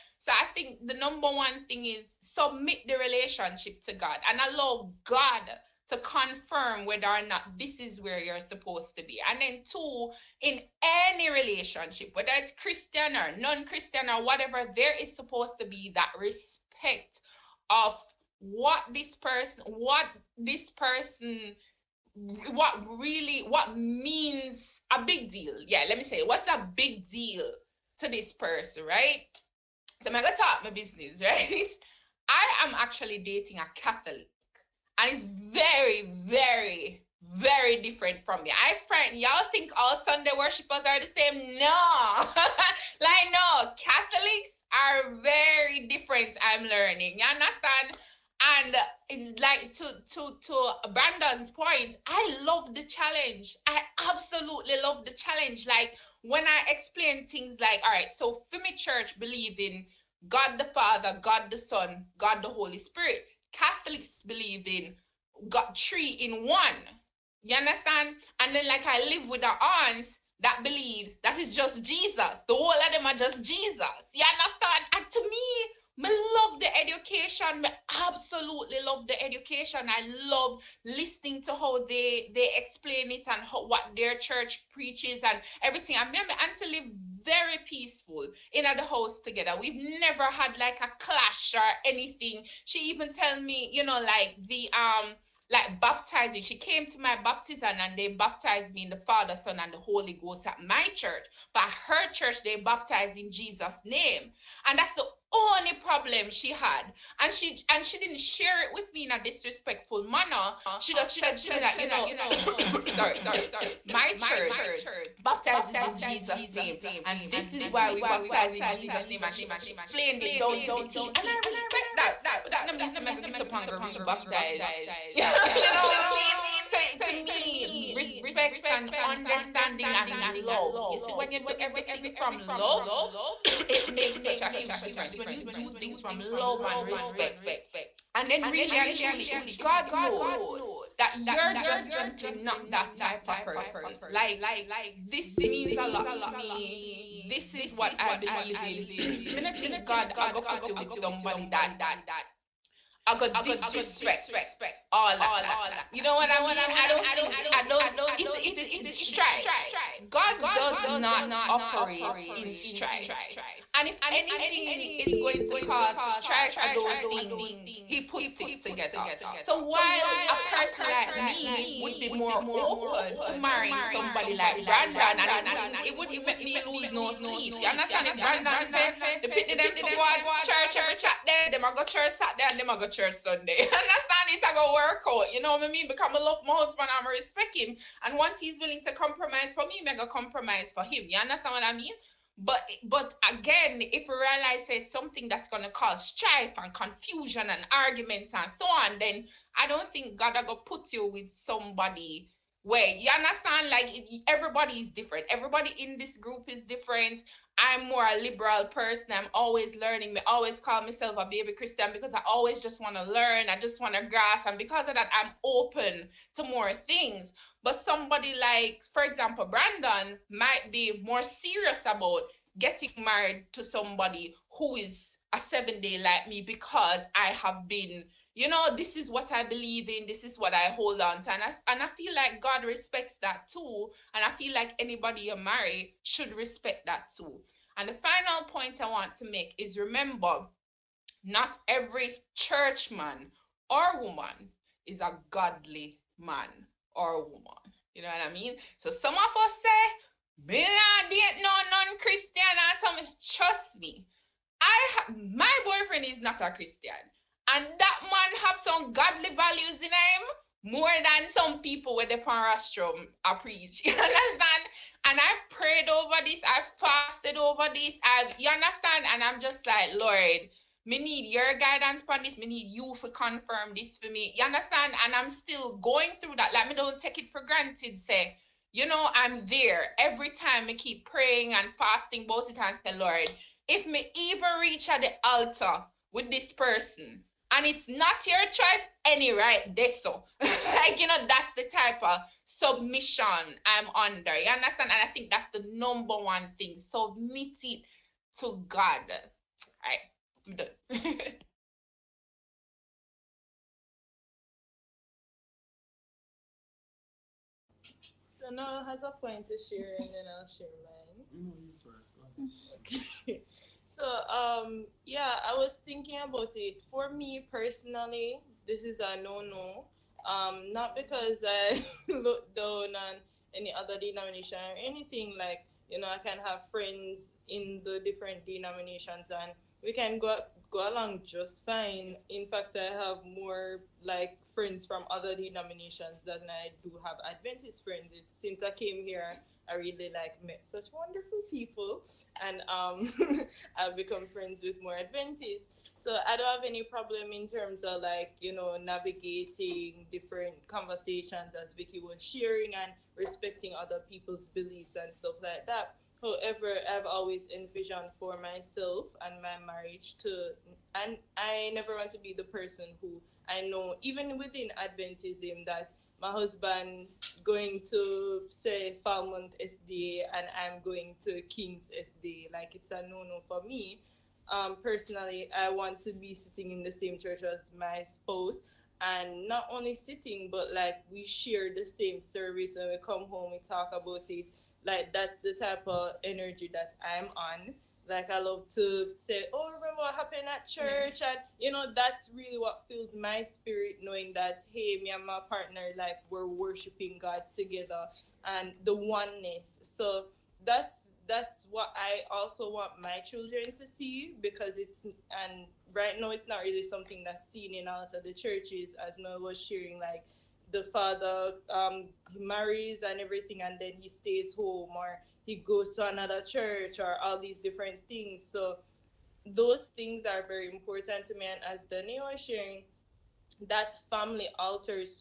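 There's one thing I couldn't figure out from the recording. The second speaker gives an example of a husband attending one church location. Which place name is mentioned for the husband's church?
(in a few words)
Falmouth.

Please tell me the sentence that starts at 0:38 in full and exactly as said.
I friend, y'all think all Sunday worshippers are the same?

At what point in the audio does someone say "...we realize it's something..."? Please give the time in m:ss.
3:14.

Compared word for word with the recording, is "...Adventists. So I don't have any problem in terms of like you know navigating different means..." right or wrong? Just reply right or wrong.
wrong.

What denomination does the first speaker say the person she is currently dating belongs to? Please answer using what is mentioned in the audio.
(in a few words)
Catholic.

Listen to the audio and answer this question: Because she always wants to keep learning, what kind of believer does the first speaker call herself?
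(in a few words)
A baby Christian.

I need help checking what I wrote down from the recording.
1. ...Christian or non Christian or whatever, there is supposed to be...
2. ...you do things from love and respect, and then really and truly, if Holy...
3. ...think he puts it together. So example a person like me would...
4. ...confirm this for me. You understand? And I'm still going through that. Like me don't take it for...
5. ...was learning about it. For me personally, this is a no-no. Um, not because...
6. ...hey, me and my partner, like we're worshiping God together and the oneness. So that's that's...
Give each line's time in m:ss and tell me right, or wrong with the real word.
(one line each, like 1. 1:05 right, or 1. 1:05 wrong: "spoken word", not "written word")
1. 0:12 right
2. 2:15 wrong: "God", not "Holy"
3. 2:47 wrong: "while", not "example"
4. 4:33 right
5. 5:15 wrong: "thinking", not "learning"
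6. 6:34 right.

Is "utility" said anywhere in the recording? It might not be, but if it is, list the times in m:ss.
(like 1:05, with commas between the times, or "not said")
not said.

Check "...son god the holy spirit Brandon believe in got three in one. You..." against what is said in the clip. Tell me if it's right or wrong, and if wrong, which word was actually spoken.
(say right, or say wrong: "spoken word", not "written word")
wrong: "Catholics", not "Brandon".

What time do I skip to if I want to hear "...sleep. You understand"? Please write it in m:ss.
2:57.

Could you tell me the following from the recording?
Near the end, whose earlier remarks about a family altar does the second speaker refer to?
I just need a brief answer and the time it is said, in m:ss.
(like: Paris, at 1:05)
Daniel, at 7:01.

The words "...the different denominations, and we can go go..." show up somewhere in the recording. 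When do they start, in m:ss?
5:27.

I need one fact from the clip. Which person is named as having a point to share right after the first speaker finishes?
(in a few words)
Noel.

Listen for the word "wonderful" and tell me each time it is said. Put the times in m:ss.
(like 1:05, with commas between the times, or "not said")
5:40.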